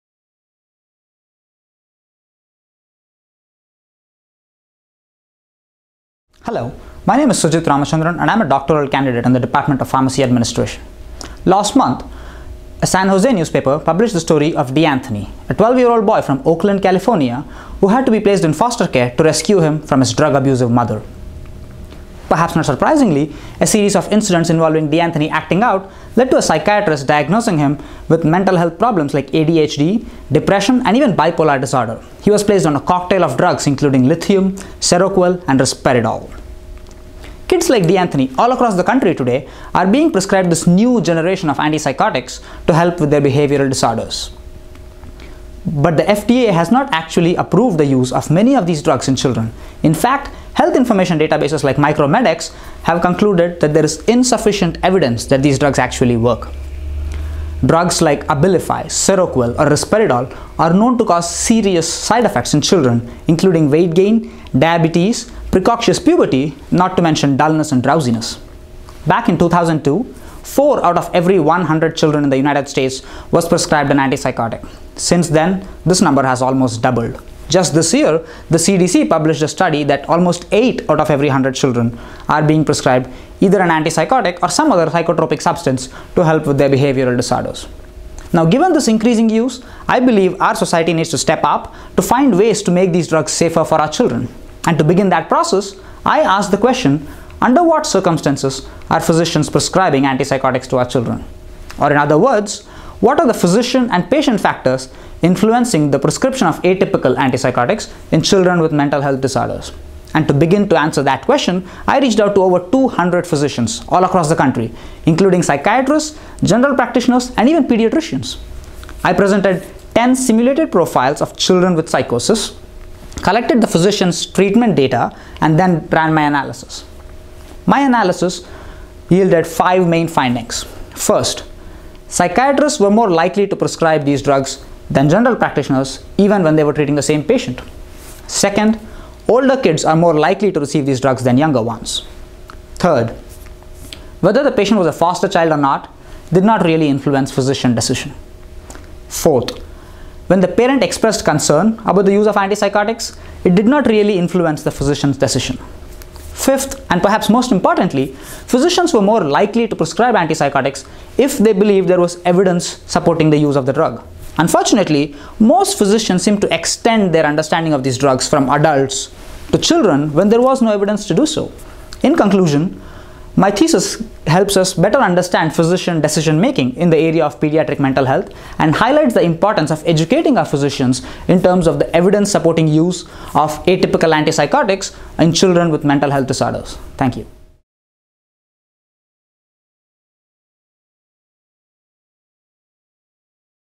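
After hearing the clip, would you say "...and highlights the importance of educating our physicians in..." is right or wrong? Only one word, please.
right.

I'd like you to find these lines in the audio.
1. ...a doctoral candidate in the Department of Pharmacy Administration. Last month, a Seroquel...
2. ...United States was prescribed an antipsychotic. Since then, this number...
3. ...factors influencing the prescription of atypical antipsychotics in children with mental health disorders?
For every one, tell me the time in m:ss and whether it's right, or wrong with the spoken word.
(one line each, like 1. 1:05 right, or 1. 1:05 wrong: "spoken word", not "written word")
1. 0:08 wrong: "San", not "Seroquel"
2. 1:12 right
3. 1:44 right.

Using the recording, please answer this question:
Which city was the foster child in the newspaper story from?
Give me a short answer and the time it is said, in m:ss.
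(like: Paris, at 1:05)
Oakland, at 0:16.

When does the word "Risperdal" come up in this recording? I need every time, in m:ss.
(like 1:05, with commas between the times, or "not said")
0:35, 0:59.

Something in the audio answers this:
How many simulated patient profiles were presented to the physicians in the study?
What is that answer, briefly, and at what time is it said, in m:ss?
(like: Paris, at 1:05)
10, at 1:59.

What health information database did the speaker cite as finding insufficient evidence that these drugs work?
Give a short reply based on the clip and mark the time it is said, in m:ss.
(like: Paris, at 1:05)
Micromedex, at 0:51.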